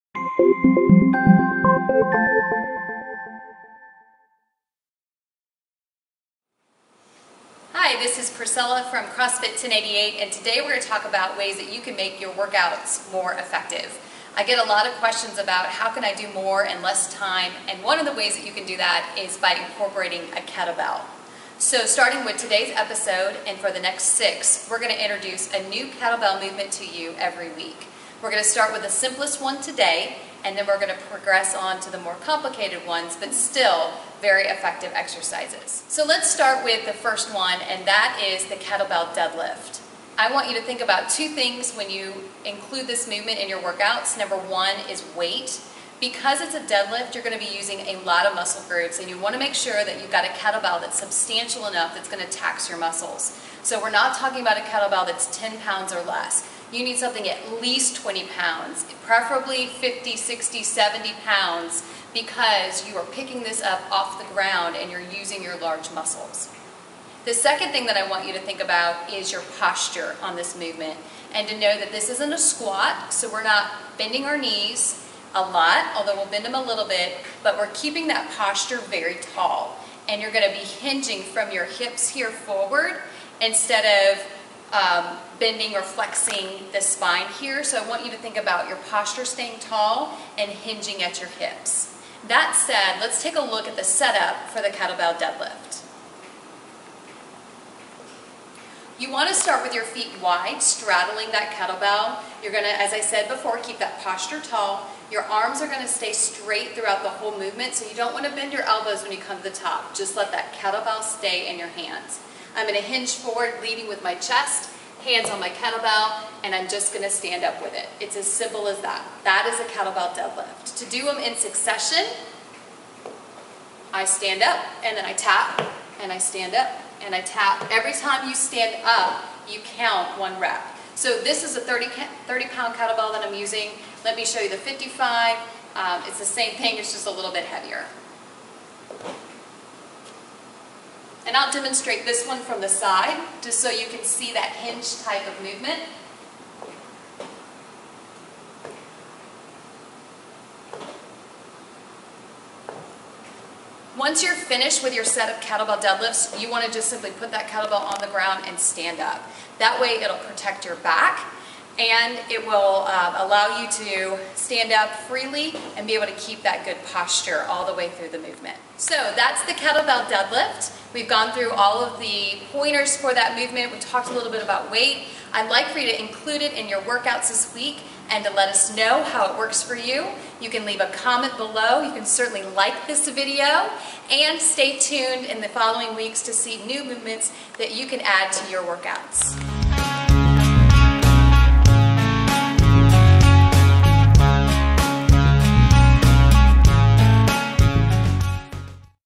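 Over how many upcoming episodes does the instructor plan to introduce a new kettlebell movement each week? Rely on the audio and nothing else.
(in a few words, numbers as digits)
6.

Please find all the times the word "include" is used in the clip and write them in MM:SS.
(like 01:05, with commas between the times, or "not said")
00:42, 02:56.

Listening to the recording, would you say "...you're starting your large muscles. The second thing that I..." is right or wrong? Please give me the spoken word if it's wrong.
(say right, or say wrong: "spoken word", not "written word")
wrong: "using", not "starting".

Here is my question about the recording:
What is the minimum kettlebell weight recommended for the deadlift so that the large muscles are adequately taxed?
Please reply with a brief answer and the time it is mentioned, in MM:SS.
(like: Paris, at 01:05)
20 pounds, at 00:57.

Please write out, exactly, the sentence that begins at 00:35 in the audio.
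So let's start with the first one, and that is the kettlebell deadlift.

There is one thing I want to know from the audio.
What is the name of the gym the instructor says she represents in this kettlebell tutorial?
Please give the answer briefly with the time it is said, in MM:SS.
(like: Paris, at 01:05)
CrossFit 1088, at 00:09.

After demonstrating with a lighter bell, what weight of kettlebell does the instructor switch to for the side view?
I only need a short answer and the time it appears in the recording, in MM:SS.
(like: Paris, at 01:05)
55 pounds, at 02:14.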